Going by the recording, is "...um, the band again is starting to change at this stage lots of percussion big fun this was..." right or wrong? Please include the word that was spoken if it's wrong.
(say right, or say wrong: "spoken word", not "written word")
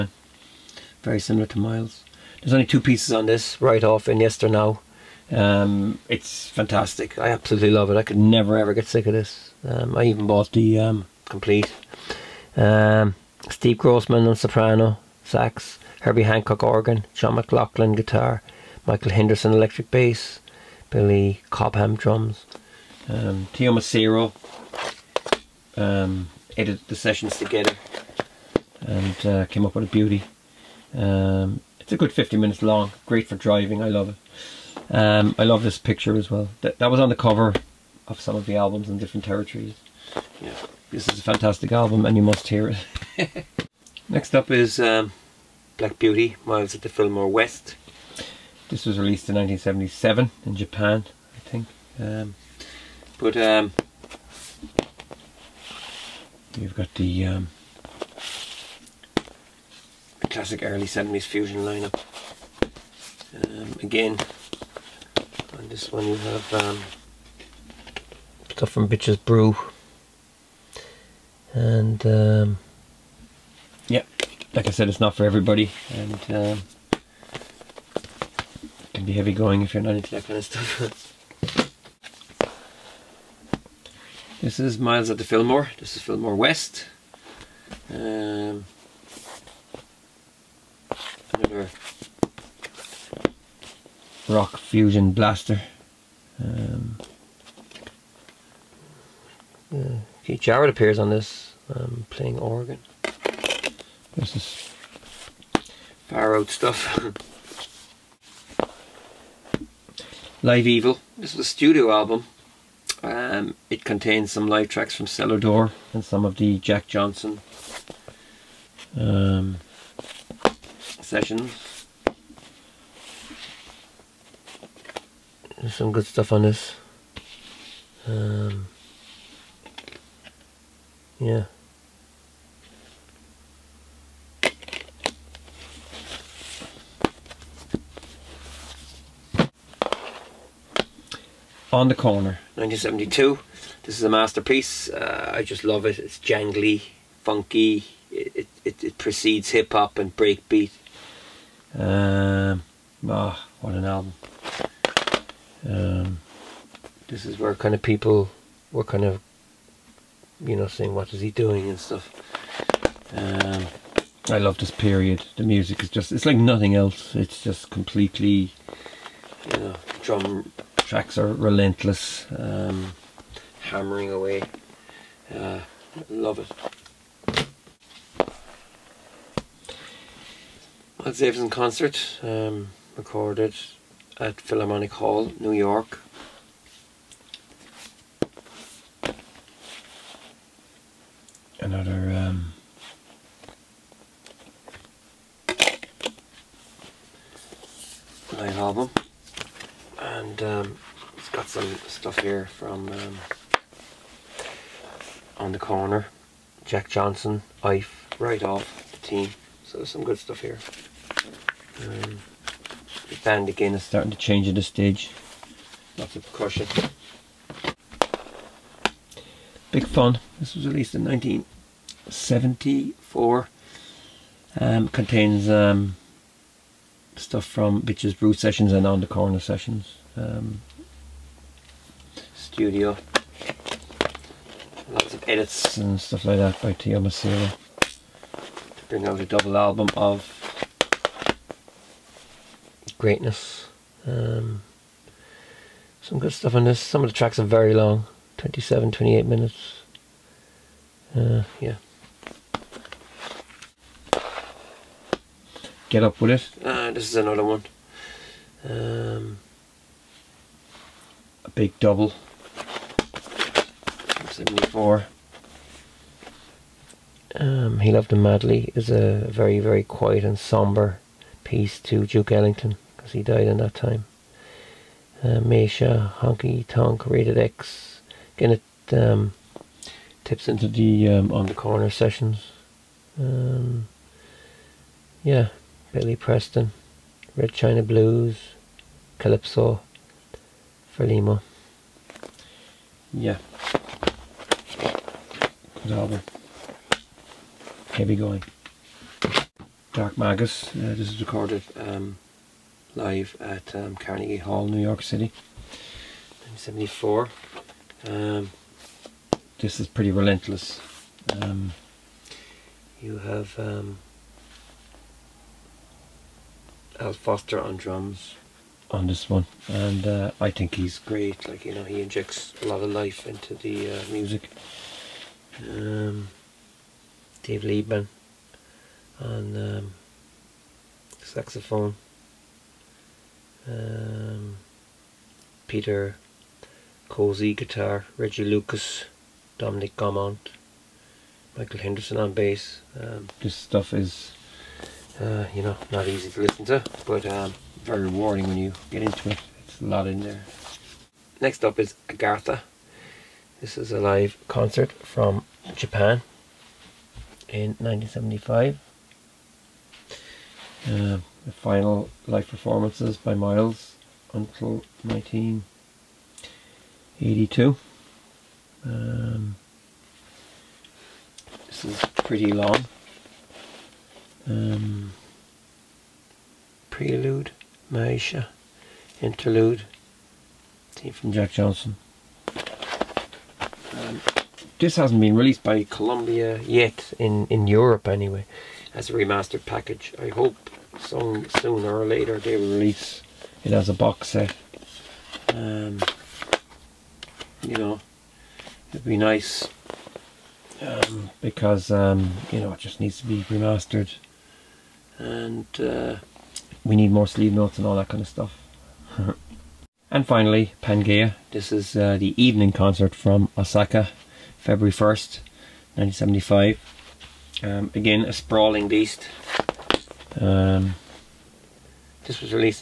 right.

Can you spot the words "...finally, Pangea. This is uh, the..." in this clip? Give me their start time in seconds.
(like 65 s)
410 s.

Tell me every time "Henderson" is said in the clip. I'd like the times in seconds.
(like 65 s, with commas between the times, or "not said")
19 s, 341 s.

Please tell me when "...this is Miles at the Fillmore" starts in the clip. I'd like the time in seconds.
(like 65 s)
84 s.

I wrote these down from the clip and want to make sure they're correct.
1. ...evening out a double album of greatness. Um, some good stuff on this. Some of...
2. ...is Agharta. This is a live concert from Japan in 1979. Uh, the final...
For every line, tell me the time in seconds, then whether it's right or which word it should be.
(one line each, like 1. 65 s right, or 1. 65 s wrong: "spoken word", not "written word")
1. 238 s wrong: "bring", not "evening"
2. 351 s wrong: "1975", not "1979".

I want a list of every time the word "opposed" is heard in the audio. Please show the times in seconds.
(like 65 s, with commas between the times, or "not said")
not said.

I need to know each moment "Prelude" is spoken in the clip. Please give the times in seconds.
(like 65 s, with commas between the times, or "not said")
376 s.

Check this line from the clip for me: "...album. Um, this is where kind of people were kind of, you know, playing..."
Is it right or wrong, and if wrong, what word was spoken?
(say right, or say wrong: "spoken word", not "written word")
wrong: "saying", not "playing".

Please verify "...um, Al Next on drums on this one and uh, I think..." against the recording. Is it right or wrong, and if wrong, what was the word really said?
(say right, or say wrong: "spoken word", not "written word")
wrong: "Foster", not "Next".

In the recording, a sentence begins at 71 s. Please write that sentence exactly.
And um, yeah, like I said, it's not for everybody.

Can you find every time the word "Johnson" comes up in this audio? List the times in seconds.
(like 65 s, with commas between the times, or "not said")
116 s, 206 s, 381 s.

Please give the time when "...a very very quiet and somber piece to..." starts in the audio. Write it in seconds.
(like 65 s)
268 s.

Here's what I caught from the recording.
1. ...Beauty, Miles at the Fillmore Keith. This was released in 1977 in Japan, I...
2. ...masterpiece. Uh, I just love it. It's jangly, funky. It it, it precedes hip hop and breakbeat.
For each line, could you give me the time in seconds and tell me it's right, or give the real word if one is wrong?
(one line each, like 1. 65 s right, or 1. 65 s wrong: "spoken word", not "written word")
1. 45 s wrong: "West", not "Keith"
2. 144 s right.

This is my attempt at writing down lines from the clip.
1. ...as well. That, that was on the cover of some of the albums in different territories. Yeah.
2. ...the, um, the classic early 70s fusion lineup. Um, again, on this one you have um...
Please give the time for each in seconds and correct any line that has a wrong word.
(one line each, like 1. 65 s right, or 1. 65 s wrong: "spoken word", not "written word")
1. 36 s right
2. 56 s right.